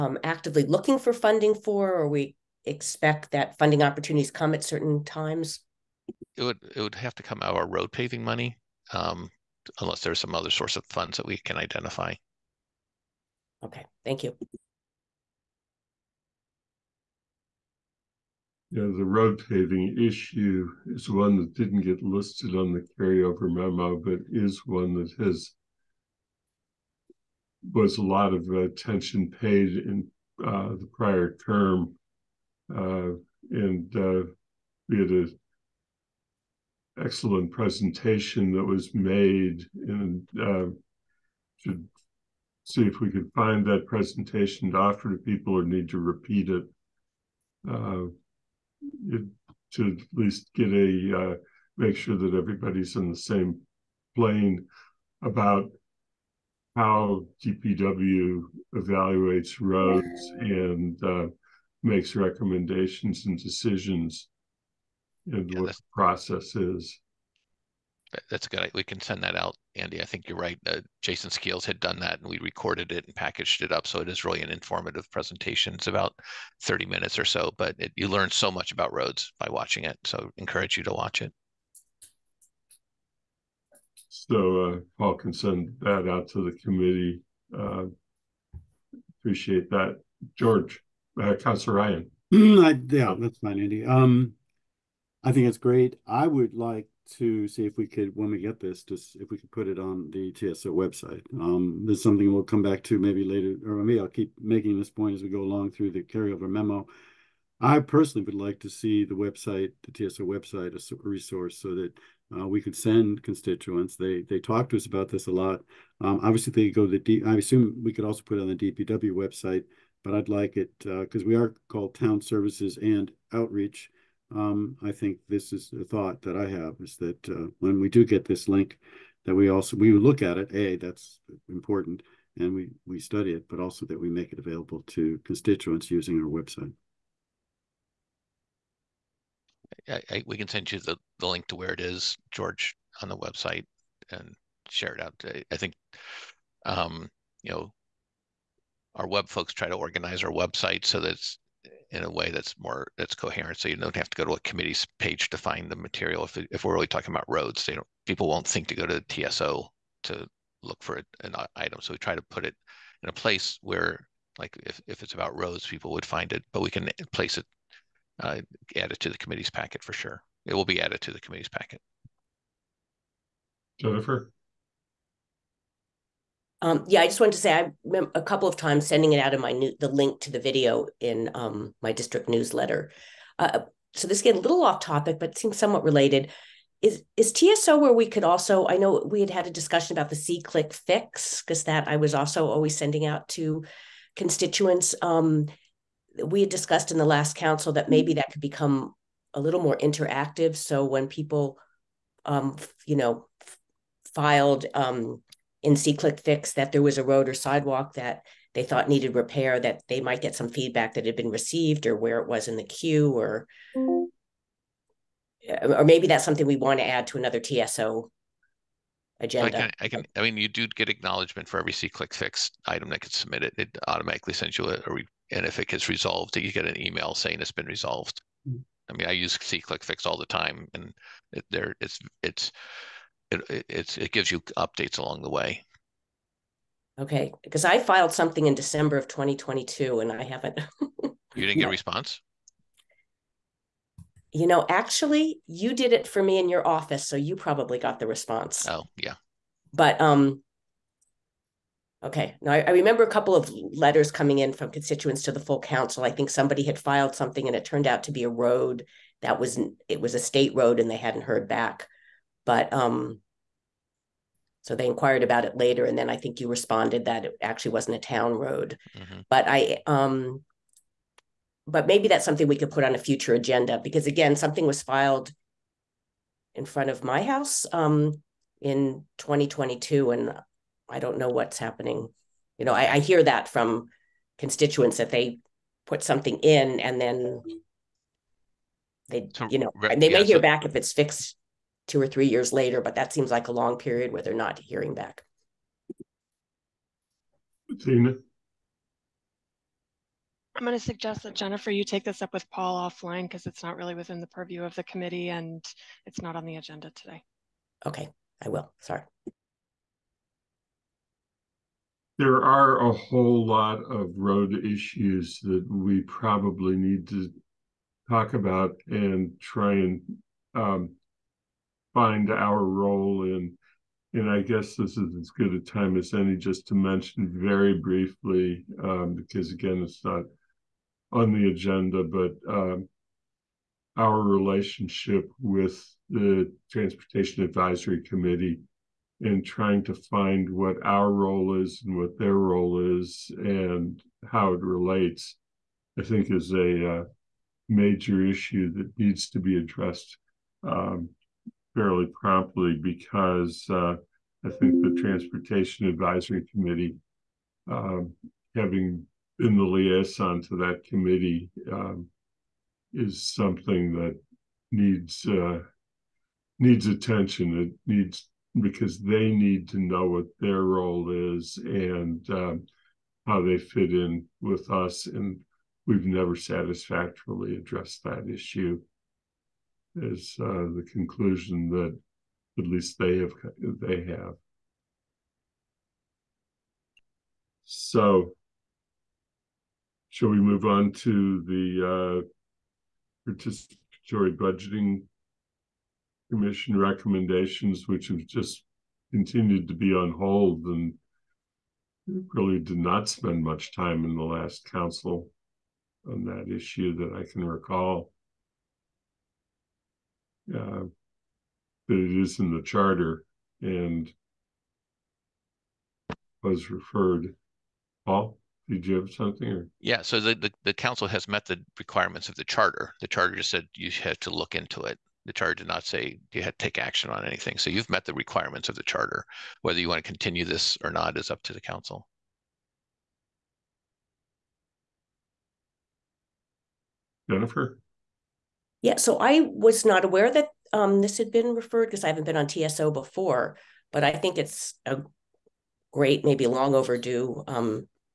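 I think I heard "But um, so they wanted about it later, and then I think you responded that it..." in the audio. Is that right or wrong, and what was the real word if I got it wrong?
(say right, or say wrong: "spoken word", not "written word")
wrong: "inquired", not "wanted".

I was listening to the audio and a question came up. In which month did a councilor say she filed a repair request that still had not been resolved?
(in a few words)
December.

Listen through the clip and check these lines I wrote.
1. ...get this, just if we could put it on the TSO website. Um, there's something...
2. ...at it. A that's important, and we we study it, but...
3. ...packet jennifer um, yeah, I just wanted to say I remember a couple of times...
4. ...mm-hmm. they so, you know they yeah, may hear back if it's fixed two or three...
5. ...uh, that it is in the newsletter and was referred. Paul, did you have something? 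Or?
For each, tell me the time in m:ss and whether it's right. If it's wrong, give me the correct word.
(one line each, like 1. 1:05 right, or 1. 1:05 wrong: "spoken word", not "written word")
1. 1:38 right
2. 2:10 right
3. 2:51 right
4. 4:47 right
5. 6:50 wrong: "charter", not "newsletter".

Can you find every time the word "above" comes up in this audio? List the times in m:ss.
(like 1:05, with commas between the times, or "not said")
not said.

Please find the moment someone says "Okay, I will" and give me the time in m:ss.
5:07.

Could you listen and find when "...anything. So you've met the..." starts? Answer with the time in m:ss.
7:07.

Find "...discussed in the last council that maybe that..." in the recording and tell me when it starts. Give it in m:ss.
3:16.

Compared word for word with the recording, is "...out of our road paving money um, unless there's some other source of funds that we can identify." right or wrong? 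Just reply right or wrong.
right.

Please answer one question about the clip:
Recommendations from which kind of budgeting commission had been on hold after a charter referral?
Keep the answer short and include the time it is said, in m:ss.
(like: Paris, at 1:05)
Participatory budgeting, at 6:33.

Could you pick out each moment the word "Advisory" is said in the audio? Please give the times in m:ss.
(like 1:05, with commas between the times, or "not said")
5:37, 5:55.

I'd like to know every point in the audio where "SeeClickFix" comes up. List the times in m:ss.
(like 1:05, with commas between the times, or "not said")
3:10, 3:25, 3:41, 3:49.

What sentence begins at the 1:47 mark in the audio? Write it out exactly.
I personally would like to see the website, the TSO website, as a resource so that uh, we could send constituents.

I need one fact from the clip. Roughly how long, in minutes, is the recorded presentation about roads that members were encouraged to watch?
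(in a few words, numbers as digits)
30 minutes.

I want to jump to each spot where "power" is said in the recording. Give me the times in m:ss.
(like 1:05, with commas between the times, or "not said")
not said.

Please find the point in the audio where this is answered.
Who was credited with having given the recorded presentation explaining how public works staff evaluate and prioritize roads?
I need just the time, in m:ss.
1:11.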